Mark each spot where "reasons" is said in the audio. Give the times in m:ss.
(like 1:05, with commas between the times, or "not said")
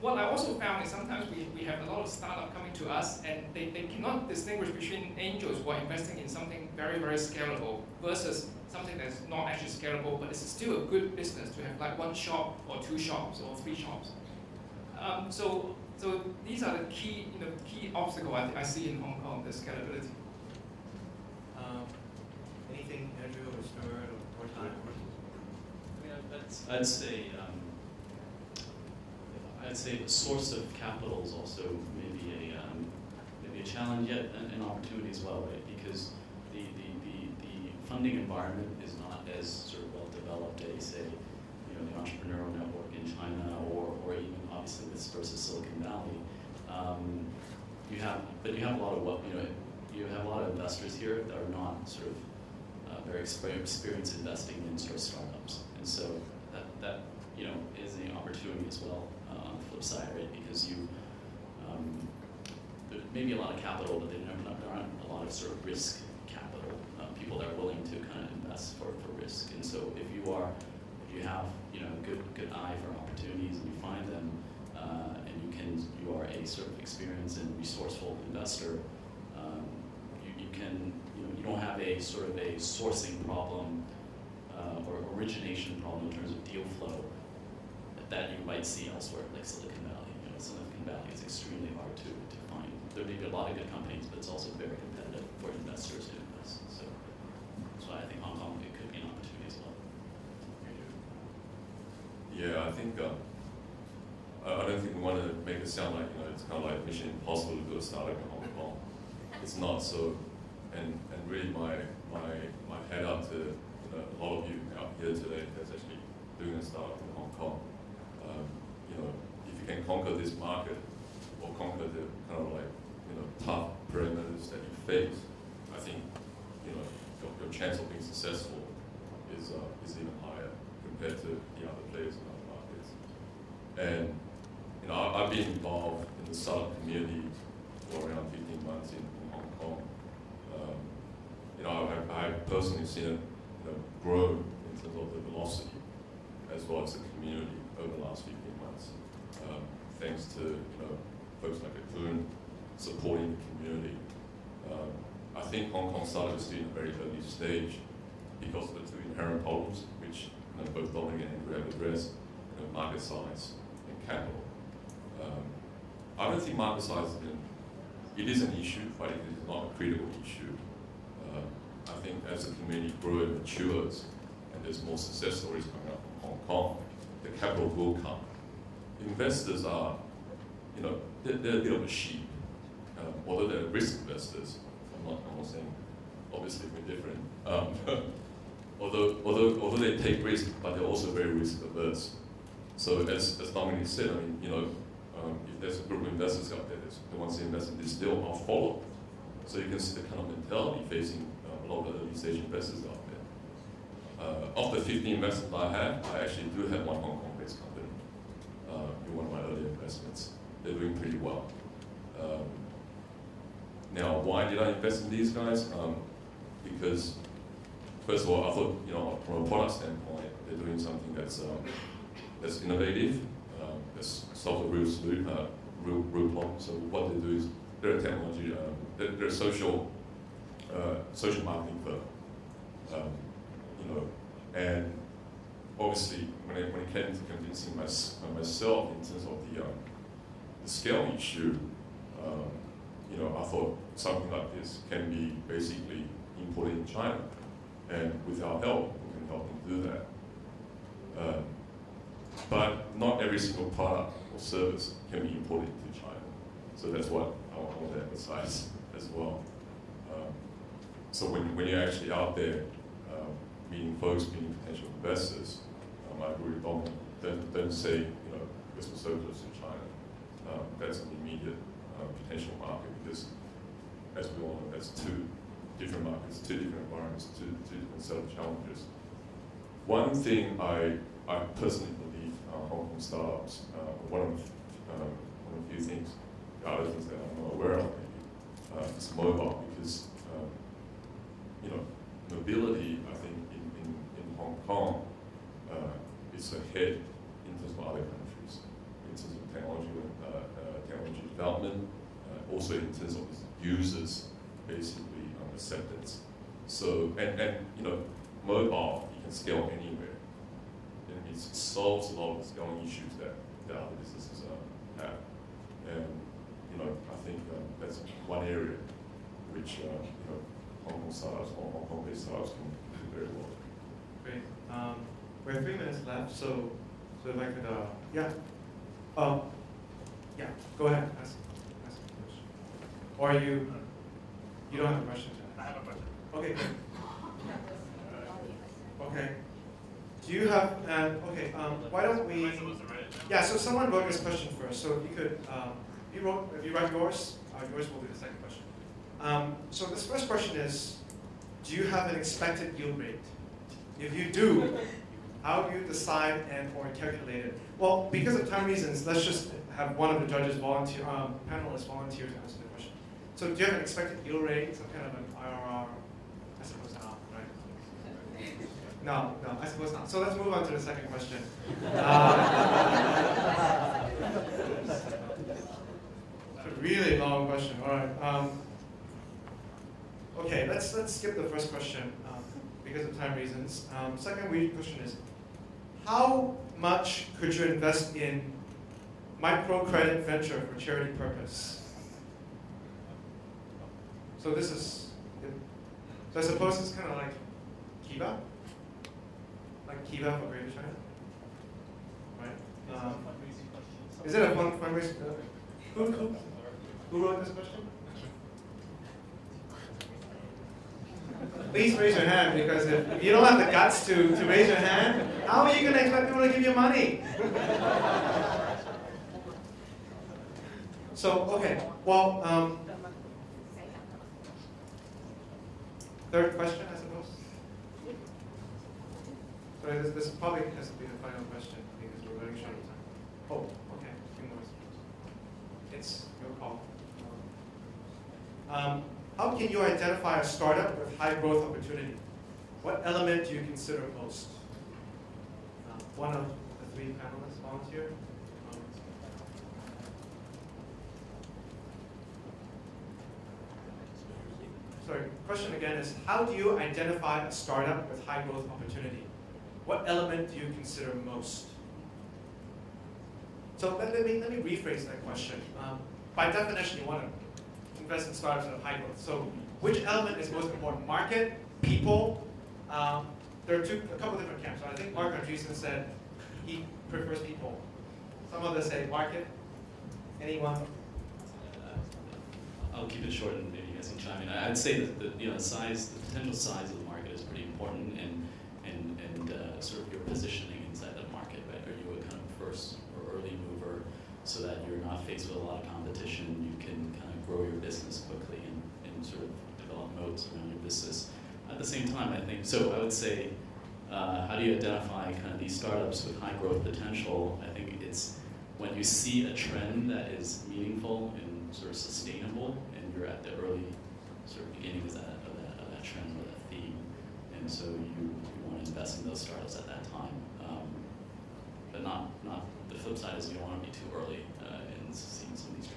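5:58, 6:23.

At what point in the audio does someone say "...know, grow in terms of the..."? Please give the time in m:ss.
2:23.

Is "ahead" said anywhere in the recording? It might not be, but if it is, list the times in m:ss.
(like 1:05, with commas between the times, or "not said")
4:56, 5:30.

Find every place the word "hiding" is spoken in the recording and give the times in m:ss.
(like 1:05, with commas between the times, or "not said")
not said.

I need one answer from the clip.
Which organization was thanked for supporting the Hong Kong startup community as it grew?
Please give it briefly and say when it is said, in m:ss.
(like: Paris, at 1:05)
CoCoon, at 2:31.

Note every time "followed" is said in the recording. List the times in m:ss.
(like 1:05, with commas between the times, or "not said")
3:18.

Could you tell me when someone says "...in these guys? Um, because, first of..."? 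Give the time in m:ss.
3:35.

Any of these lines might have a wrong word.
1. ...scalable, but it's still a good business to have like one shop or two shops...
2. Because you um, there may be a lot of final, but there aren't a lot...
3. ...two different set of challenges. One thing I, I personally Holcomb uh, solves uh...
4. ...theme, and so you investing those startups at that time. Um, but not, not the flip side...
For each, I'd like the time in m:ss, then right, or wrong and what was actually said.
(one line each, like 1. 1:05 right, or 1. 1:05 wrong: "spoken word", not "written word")
1. 0:09 right
2. 1:00 wrong: "capital", not "final"
3. 4:37 right
4. 8:36 right.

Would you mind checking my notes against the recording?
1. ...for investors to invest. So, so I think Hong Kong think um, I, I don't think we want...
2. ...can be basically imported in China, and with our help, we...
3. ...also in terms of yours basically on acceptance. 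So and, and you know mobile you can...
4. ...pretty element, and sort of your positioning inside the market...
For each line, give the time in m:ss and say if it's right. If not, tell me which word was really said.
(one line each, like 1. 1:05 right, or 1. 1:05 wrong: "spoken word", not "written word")
1. 1:35 right
2. 4:04 right
3. 5:02 wrong: "users", not "yours"
4. 8:07 wrong: "important", not "element".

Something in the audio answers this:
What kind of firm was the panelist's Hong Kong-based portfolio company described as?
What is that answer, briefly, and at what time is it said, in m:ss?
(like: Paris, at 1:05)
social marketing firm, at 3:51.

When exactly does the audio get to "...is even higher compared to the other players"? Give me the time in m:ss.
2:09.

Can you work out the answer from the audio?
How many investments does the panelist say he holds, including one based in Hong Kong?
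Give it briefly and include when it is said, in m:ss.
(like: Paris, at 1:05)
50, at 3:24.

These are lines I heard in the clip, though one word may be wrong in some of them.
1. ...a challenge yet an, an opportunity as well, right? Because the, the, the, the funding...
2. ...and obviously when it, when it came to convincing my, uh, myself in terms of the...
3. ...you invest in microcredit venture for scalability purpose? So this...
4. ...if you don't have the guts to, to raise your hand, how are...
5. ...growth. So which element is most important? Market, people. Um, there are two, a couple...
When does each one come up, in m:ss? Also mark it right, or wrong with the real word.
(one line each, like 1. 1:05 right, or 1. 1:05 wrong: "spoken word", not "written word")
1. 0:33 right
2. 3:54 right
3. 6:27 wrong: "charity", not "scalability"
4. 6:53 right
5. 7:48 right.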